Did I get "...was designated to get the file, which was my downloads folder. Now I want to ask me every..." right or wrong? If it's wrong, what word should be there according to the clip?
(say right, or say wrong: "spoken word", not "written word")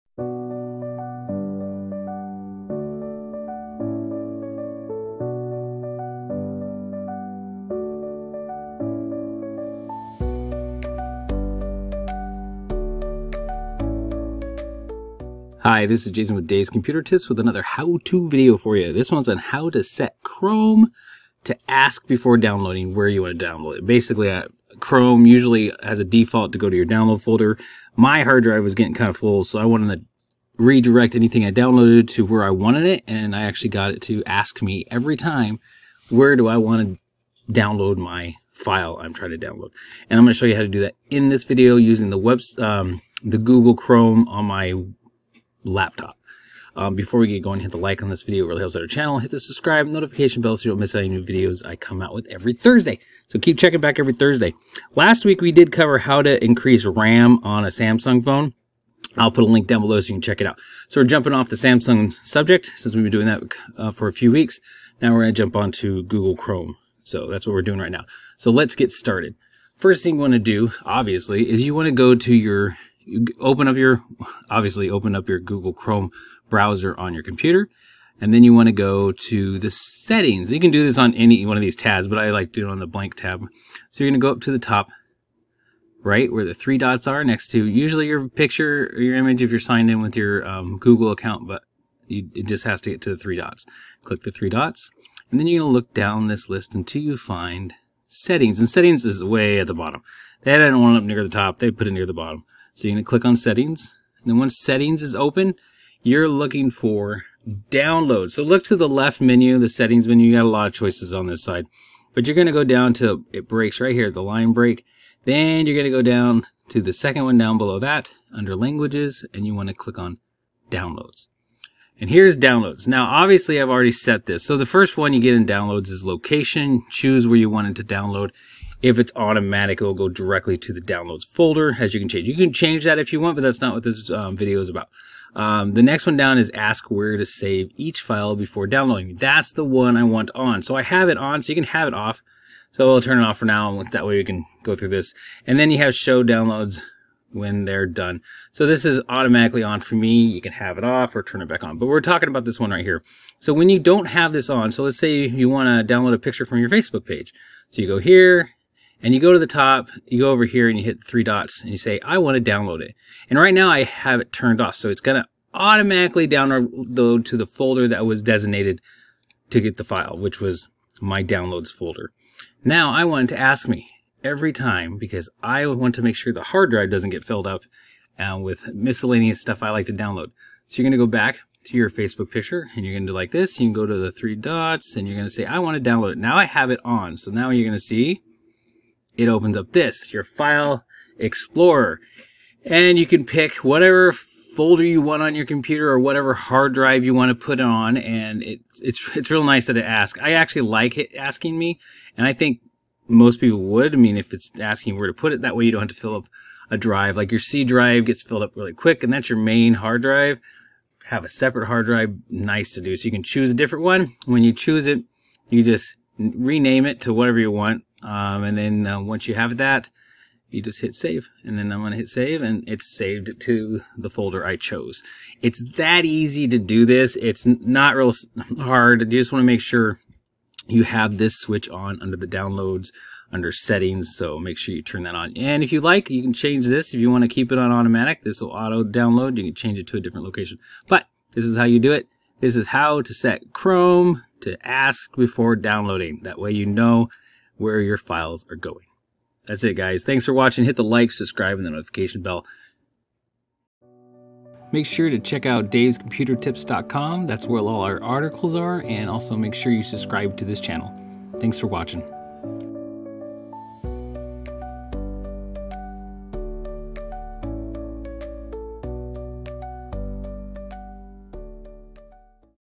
right.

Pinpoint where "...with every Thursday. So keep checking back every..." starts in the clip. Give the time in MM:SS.
00:52.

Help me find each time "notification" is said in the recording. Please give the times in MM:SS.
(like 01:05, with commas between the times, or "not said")
00:49, 04:11.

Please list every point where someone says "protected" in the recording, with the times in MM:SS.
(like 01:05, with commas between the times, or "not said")
not said.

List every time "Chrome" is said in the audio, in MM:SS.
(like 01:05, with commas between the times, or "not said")
00:20, 00:24, 00:43, 01:06, 01:15, 04:03.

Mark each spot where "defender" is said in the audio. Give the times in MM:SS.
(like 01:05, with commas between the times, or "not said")
not said.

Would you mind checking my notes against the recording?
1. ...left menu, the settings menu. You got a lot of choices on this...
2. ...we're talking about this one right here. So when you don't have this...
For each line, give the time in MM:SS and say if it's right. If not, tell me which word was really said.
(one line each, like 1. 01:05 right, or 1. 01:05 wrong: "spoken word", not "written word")
1. 01:48 right
2. 02:31 right.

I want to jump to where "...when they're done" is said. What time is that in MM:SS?
02:27.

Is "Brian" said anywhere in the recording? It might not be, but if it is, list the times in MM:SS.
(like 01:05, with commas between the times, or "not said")
not said.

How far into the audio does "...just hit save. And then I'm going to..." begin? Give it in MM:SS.
03:40.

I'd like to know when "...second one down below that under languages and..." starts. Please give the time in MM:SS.
01:56.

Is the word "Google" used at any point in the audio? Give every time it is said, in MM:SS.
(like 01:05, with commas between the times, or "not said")
00:43, 01:06, 01:15, 01:30.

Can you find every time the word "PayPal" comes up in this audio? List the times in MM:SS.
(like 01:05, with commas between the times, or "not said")
not said.